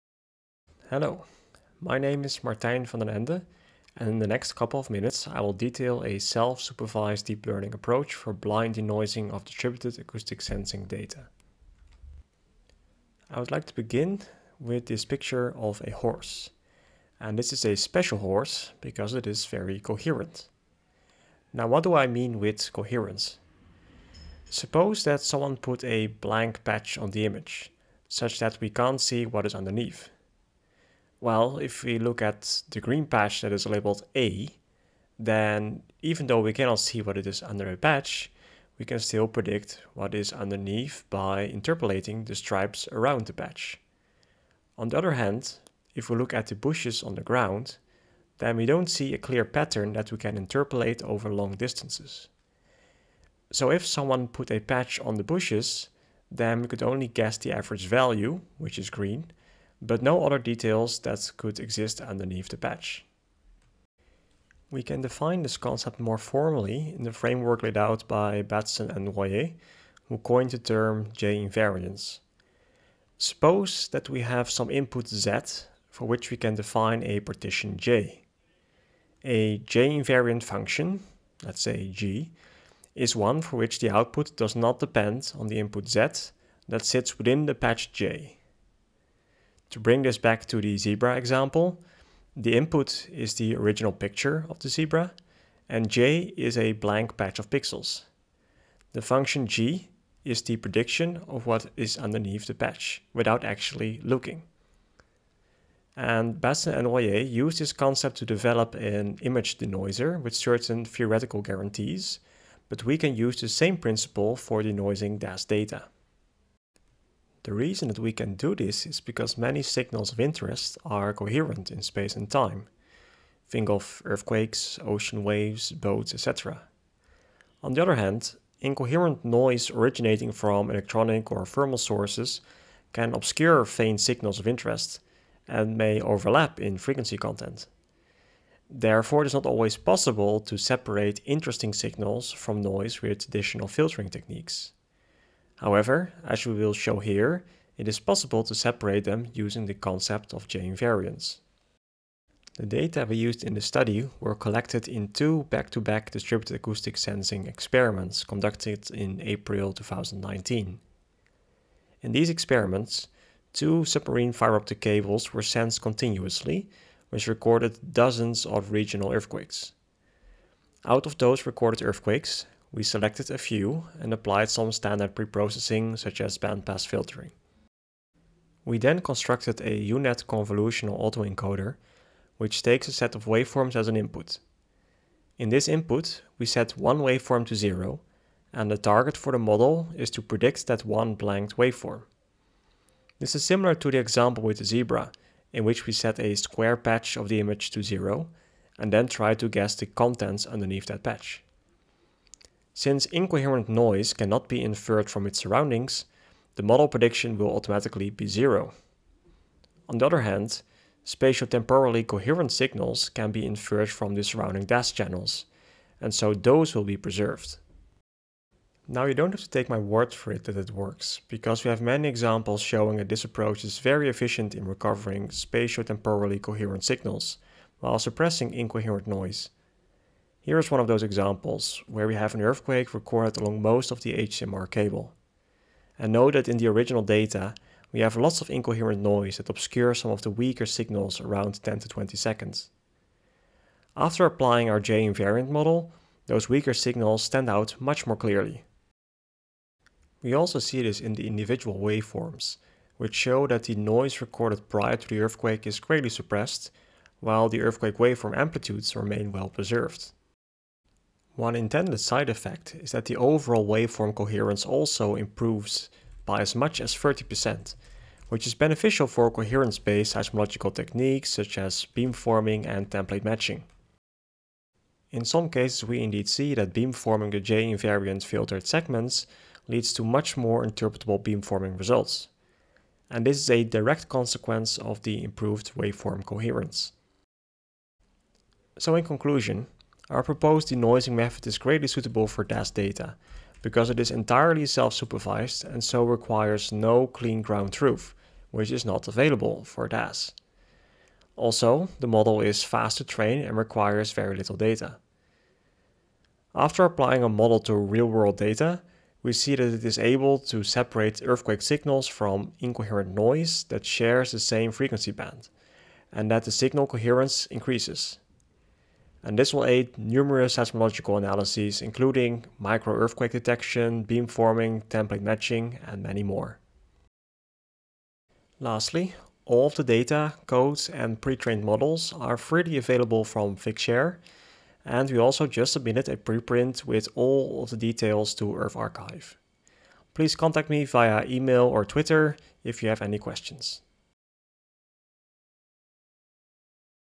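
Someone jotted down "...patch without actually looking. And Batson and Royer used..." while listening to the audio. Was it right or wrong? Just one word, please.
right.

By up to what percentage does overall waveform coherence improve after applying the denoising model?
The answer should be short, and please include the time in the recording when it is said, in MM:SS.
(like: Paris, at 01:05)
30%, at 04:26.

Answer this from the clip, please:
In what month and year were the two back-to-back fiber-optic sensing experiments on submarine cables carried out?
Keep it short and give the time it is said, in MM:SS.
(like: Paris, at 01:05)
April 2019, at 02:39.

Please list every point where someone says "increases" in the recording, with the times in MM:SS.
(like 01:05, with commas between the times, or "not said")
05:17.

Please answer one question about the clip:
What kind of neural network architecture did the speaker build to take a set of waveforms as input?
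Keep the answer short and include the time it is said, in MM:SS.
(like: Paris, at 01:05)
UNet convolutional autoencoder, at 02:59.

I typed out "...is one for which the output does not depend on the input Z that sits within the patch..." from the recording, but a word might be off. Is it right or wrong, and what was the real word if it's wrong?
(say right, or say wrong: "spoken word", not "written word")
right.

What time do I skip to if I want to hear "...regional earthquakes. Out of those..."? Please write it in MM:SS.
02:48.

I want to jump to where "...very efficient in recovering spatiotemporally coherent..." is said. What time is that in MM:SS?
03:43.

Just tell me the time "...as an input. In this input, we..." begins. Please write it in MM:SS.
03:03.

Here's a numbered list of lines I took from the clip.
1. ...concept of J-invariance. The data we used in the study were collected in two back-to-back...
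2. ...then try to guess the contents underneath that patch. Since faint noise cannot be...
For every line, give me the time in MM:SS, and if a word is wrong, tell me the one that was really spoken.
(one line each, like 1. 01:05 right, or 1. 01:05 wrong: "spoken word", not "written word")
1. 02:29 right
2. 03:18 wrong: "incoherent", not "faint".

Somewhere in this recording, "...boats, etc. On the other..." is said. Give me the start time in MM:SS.
02:05.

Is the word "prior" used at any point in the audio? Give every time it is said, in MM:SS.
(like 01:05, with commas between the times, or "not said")
04:14.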